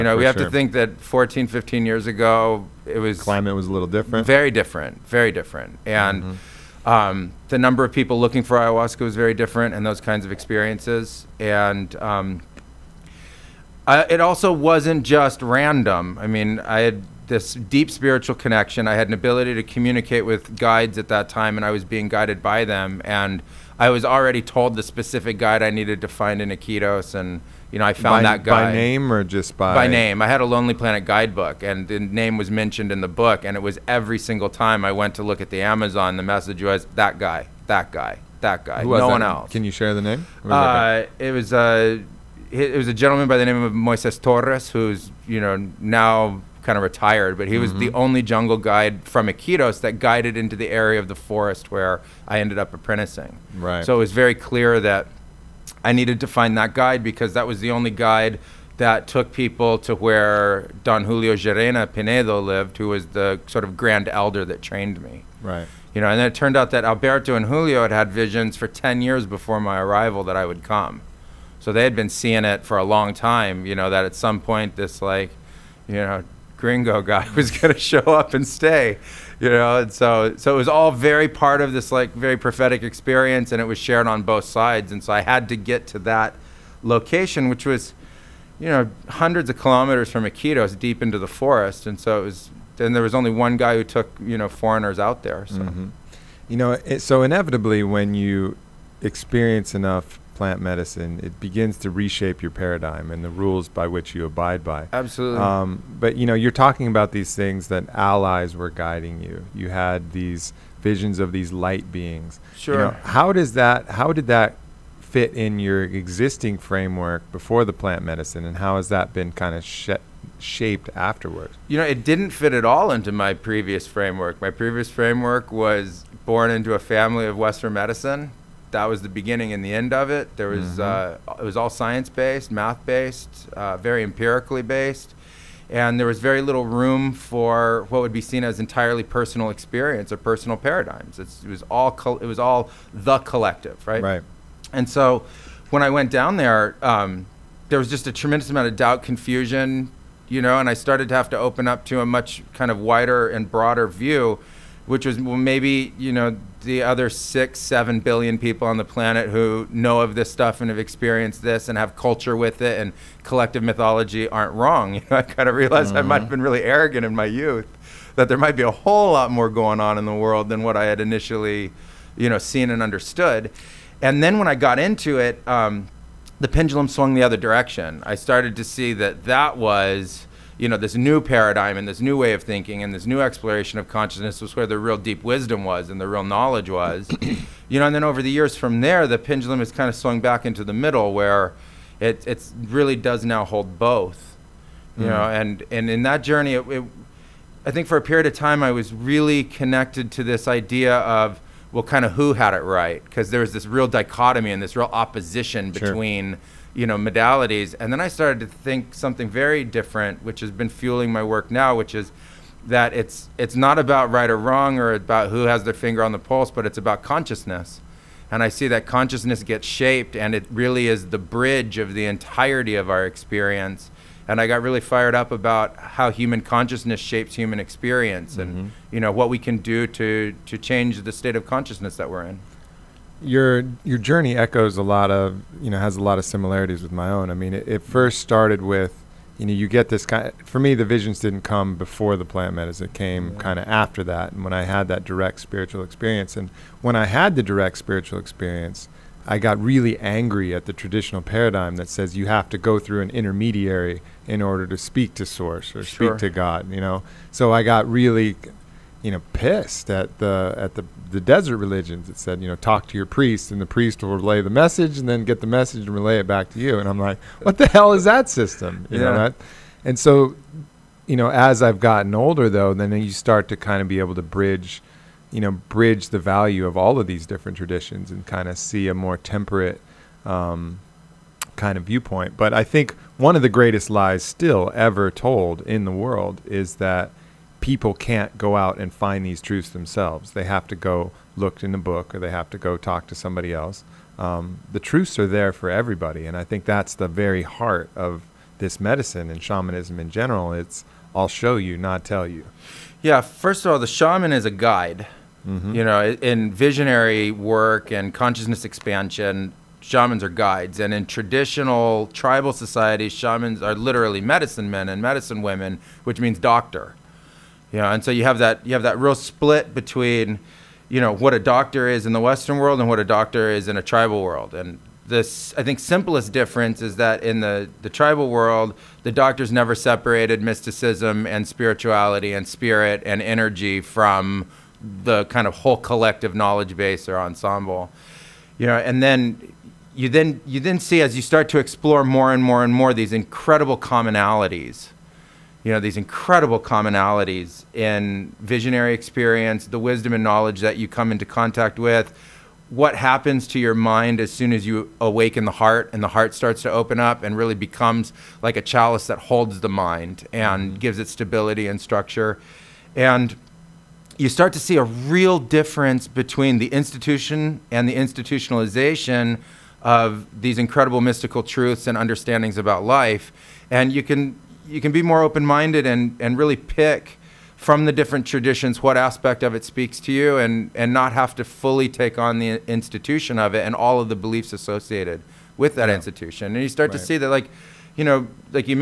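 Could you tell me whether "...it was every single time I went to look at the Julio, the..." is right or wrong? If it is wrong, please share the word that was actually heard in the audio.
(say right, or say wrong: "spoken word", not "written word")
wrong: "Amazon", not "Julio".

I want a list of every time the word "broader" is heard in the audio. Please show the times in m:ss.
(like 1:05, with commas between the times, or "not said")
2:33.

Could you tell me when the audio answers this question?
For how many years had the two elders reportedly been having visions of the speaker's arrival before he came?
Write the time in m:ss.
1:08.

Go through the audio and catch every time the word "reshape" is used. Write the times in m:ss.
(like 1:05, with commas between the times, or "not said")
1:41.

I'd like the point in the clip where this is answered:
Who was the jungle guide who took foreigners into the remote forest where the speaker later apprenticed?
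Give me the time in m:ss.
0:43.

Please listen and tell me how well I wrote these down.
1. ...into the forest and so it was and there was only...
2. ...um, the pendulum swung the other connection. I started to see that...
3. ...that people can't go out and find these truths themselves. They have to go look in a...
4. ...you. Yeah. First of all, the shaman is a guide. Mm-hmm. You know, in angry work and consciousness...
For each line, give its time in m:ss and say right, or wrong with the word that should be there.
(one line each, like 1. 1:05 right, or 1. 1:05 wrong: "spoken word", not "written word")
1. 1:31 right
2. 2:55 wrong: "direction", not "connection"
3. 4:46 right
4. 5:02 wrong: "visionary", not "angry".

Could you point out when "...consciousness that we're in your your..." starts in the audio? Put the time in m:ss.
3:51.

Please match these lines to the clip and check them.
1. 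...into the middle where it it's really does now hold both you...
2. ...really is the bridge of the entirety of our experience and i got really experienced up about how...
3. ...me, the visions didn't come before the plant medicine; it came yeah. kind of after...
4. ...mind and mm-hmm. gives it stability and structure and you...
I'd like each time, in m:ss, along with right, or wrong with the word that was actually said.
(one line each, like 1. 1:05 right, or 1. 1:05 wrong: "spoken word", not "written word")
1. 3:10 right
2. 3:40 wrong: "fired", not "experienced"
3. 4:00 right
4. 5:59 right.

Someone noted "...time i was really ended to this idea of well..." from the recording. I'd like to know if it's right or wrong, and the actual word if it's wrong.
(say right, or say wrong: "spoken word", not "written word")
wrong: "connected", not "ended".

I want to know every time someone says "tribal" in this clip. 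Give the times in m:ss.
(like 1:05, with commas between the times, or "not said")
5:12, 5:23, 5:27.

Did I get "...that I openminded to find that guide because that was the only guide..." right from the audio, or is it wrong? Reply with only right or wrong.
wrong.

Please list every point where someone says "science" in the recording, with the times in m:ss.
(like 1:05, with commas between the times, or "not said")
2:11.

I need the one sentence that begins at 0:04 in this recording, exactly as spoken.
Very different, very different, and mm-hmm.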